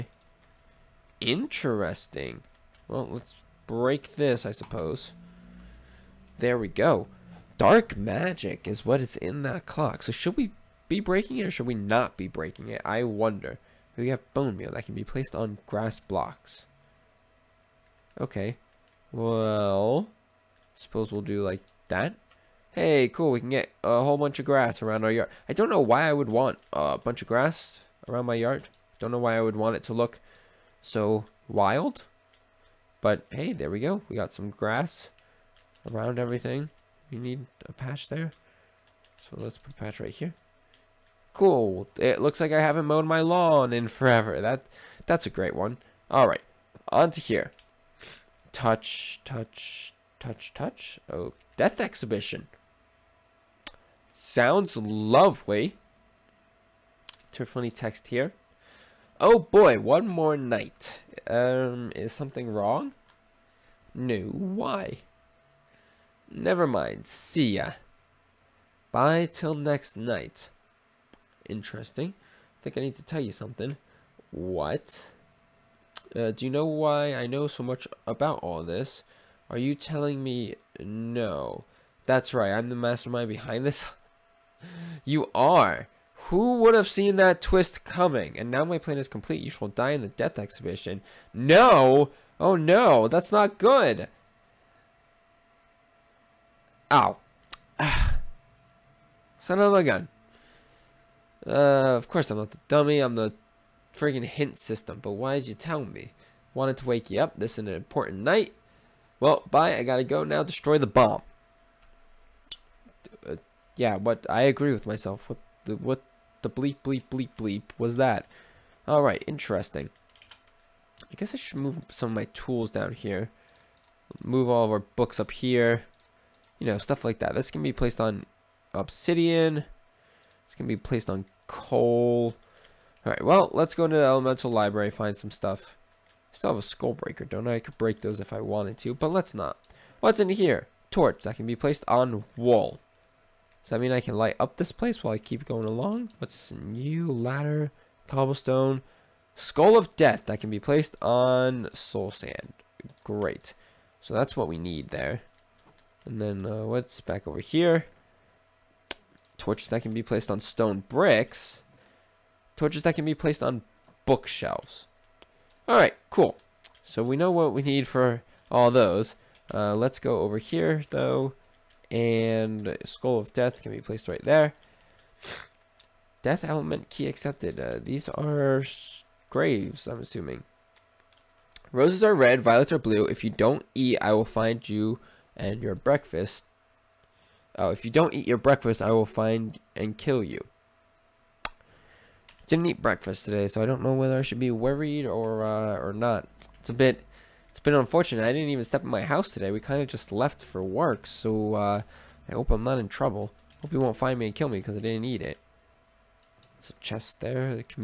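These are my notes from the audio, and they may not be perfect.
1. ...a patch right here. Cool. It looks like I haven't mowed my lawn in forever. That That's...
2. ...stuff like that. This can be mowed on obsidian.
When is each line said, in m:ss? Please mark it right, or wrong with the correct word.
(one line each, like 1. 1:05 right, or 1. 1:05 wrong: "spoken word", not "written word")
1. 0:39 right
2. 2:06 wrong: "placed", not "mowed".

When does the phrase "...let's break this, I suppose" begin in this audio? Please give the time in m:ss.
0:03.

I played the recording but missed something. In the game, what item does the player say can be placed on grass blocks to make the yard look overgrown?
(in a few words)
Bone meal.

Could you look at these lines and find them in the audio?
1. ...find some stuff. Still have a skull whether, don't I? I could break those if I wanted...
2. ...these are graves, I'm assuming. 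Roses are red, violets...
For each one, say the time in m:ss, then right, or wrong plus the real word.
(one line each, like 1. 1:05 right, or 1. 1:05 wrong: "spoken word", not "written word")
1. 2:14 wrong: "breaker", not "whether"
2. 2:57 right.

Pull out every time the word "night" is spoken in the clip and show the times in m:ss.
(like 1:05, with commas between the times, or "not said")
1:00, 1:09, 1:48.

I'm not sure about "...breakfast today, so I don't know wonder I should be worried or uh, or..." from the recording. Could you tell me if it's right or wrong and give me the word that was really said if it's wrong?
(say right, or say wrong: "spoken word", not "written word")
wrong: "whether", not "wonder".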